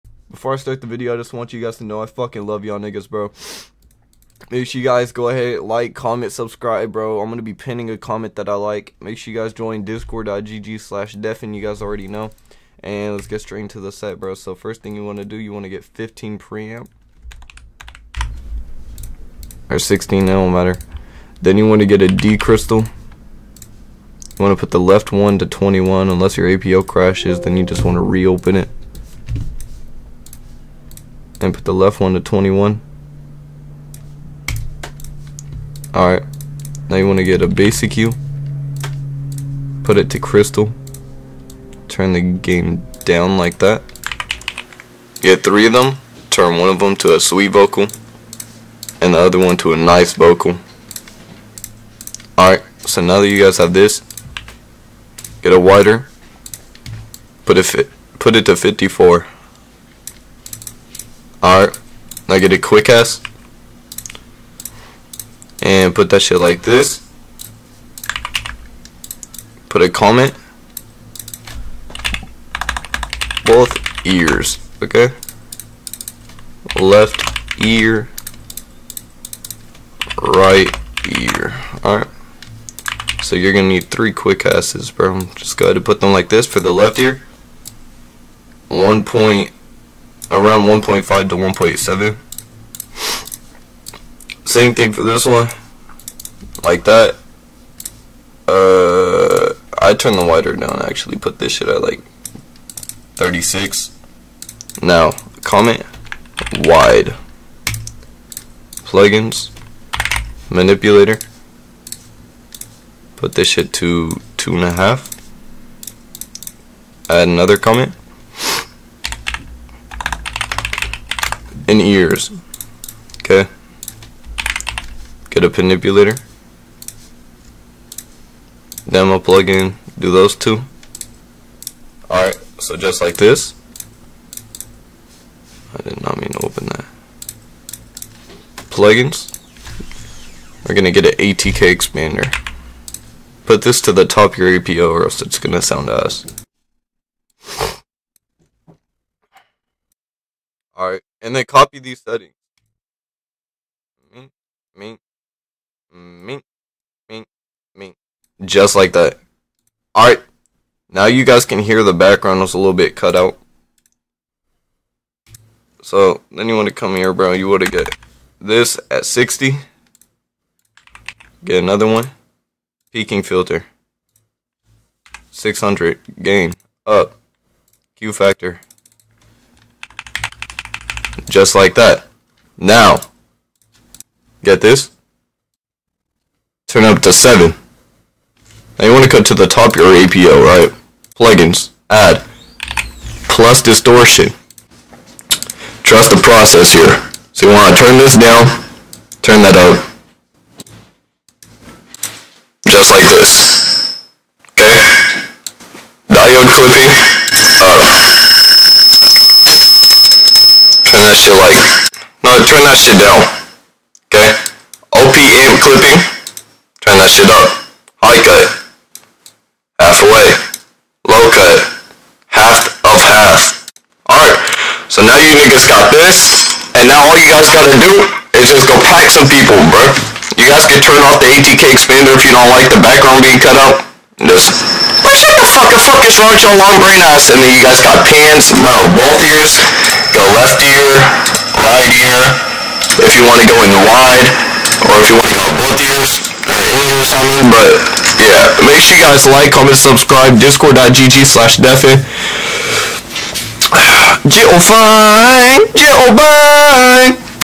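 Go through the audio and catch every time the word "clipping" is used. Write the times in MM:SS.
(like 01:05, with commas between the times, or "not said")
03:26, 03:35.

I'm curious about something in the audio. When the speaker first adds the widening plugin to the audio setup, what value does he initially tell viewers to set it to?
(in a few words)
54.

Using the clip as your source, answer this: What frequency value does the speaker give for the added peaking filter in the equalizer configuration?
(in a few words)
600.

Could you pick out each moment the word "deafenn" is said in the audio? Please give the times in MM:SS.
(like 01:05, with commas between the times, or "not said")
00:11, 04:11.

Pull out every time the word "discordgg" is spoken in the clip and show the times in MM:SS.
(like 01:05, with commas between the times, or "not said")
00:09, 04:10.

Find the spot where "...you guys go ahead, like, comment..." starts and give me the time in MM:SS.
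00:04.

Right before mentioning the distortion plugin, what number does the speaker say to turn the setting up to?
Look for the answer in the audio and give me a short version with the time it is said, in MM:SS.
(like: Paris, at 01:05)
7, at 03:07.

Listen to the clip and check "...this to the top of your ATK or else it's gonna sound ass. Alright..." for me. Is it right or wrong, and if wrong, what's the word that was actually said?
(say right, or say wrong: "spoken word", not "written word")
wrong: "APO", not "ATK".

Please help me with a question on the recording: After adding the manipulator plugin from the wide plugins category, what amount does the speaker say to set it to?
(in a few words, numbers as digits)
2.5.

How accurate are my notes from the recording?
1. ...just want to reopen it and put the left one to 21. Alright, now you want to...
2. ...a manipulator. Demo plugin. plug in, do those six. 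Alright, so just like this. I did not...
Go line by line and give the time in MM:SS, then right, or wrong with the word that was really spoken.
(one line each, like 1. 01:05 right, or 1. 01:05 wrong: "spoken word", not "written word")
1. 00:27 right
2. 02:05 wrong: "two", not "six".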